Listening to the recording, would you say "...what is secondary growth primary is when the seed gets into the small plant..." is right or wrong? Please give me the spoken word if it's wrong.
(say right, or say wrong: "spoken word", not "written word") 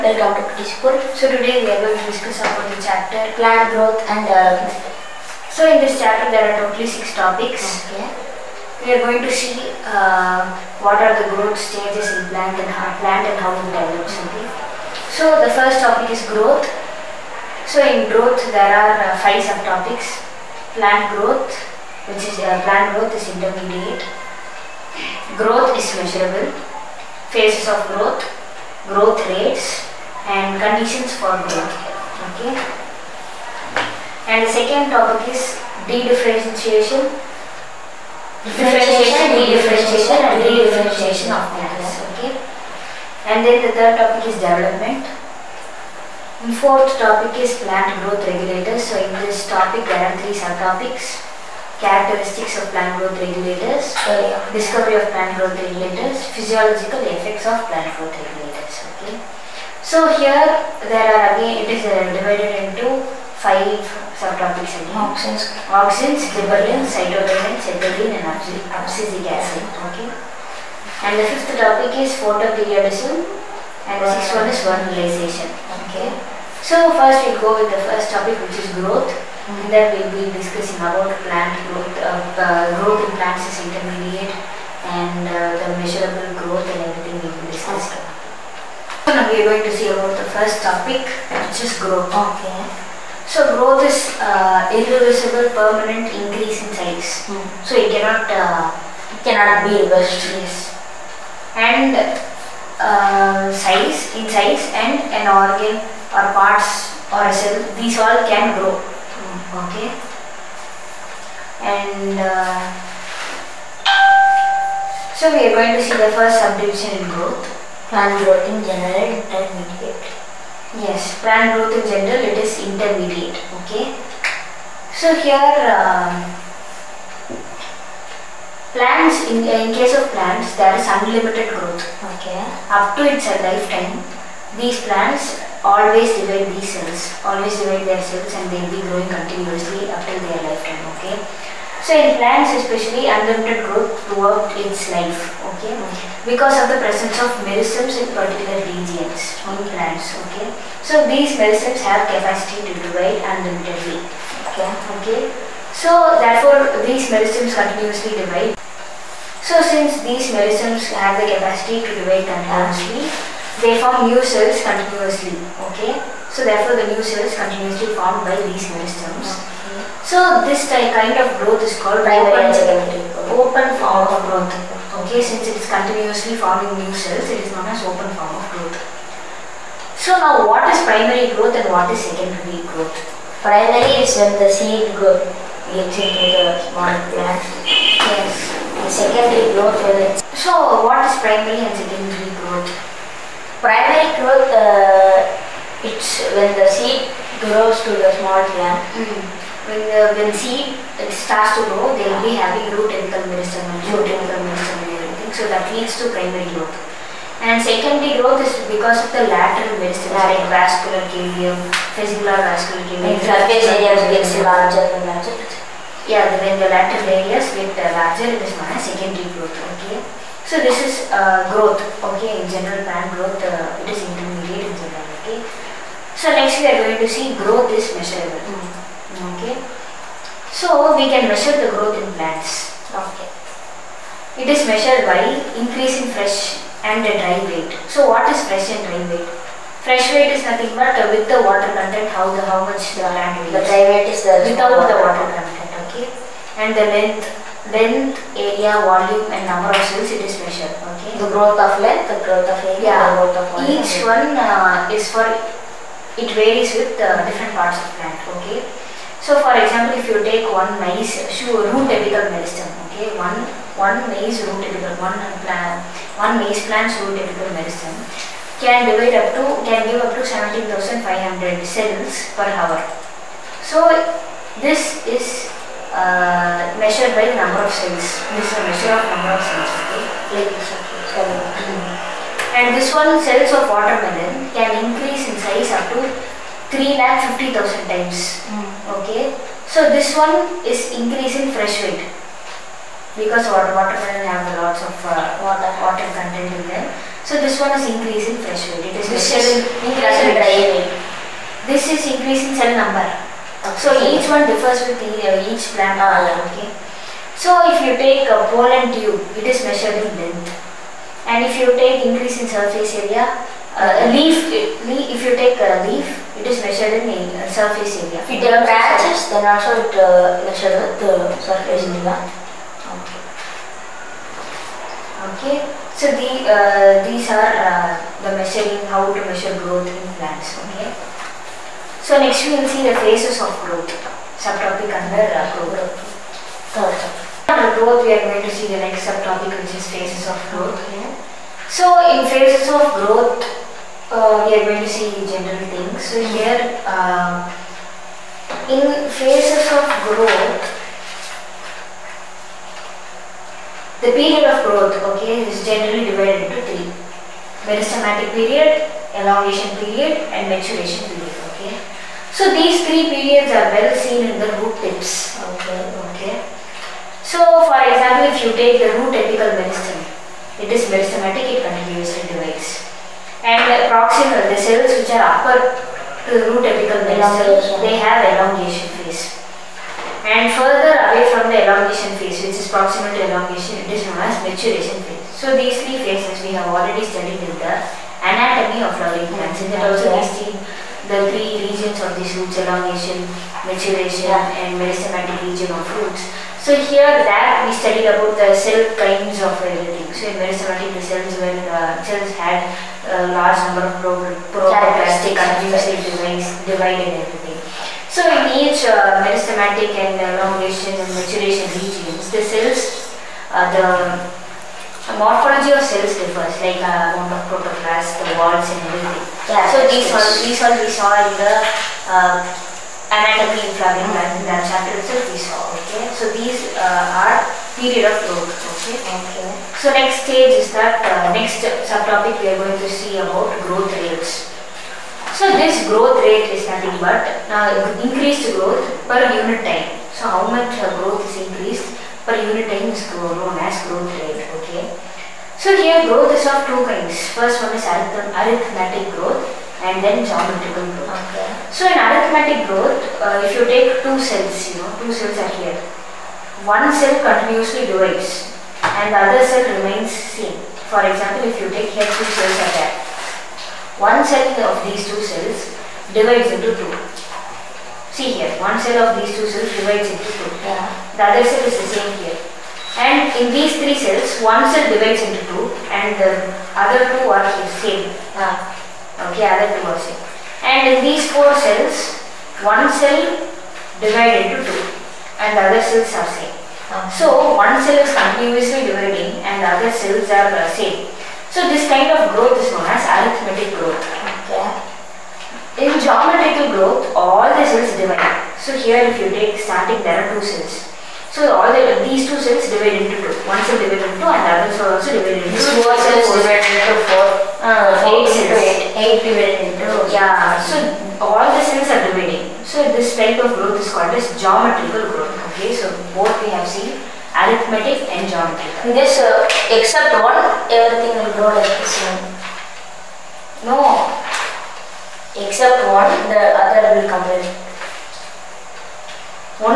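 right.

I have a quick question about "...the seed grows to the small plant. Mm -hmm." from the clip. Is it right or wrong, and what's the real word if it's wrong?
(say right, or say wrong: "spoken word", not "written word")
right.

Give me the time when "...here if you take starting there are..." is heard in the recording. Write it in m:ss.
8:18.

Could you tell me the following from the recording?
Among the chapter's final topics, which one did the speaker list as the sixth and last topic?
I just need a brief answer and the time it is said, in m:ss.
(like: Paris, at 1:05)
Vernalization, at 1:14.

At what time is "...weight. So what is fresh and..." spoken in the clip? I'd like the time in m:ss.
3:57.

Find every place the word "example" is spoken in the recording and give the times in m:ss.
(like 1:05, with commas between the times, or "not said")
4:19, 6:07, 7:41.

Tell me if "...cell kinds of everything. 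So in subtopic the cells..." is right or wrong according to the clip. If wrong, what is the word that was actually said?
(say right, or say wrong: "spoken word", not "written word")
wrong: "meristematic", not "subtopic".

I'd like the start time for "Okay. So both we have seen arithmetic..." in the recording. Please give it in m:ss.
8:35.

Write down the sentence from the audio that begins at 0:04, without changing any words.
Uh, so in this chapter there are totally six topics.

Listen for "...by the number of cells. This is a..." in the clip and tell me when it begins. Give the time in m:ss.
4:37.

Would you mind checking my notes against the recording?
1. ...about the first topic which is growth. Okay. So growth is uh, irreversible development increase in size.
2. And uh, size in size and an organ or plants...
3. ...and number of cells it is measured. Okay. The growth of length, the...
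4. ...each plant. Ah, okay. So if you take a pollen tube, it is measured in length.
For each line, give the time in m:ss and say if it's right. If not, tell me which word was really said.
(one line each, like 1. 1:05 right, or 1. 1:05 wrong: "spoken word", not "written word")
1. 1:29 wrong: "permanent", not "development"
2. 1:41 wrong: "parts", not "plants"
3. 4:09 right
4. 5:05 right.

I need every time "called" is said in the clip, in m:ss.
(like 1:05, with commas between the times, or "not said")
2:51, 8:33.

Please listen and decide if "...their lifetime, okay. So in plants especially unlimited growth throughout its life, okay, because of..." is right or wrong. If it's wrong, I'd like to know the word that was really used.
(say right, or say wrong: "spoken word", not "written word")
right.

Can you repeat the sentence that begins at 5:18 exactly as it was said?
If there are branches, then also it uh, measured with the surface area.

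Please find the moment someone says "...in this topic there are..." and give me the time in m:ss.
0:49.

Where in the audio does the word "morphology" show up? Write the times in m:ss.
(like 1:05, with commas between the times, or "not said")
6:55.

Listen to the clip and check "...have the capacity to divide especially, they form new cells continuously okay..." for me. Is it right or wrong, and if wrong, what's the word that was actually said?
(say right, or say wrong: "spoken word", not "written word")
wrong: "continuously", not "especially".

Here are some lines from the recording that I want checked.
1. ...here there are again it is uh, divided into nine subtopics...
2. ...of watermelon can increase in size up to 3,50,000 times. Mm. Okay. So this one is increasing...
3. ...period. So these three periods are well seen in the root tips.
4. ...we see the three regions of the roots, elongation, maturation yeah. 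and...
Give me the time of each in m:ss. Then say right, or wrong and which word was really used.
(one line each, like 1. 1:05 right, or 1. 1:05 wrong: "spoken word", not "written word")
1. 1:00 wrong: "five", not "nine"
2. 4:43 right
3. 6:01 right
4. 6:30 right.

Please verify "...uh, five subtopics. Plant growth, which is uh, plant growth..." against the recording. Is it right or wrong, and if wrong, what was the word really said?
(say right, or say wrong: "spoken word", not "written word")
right.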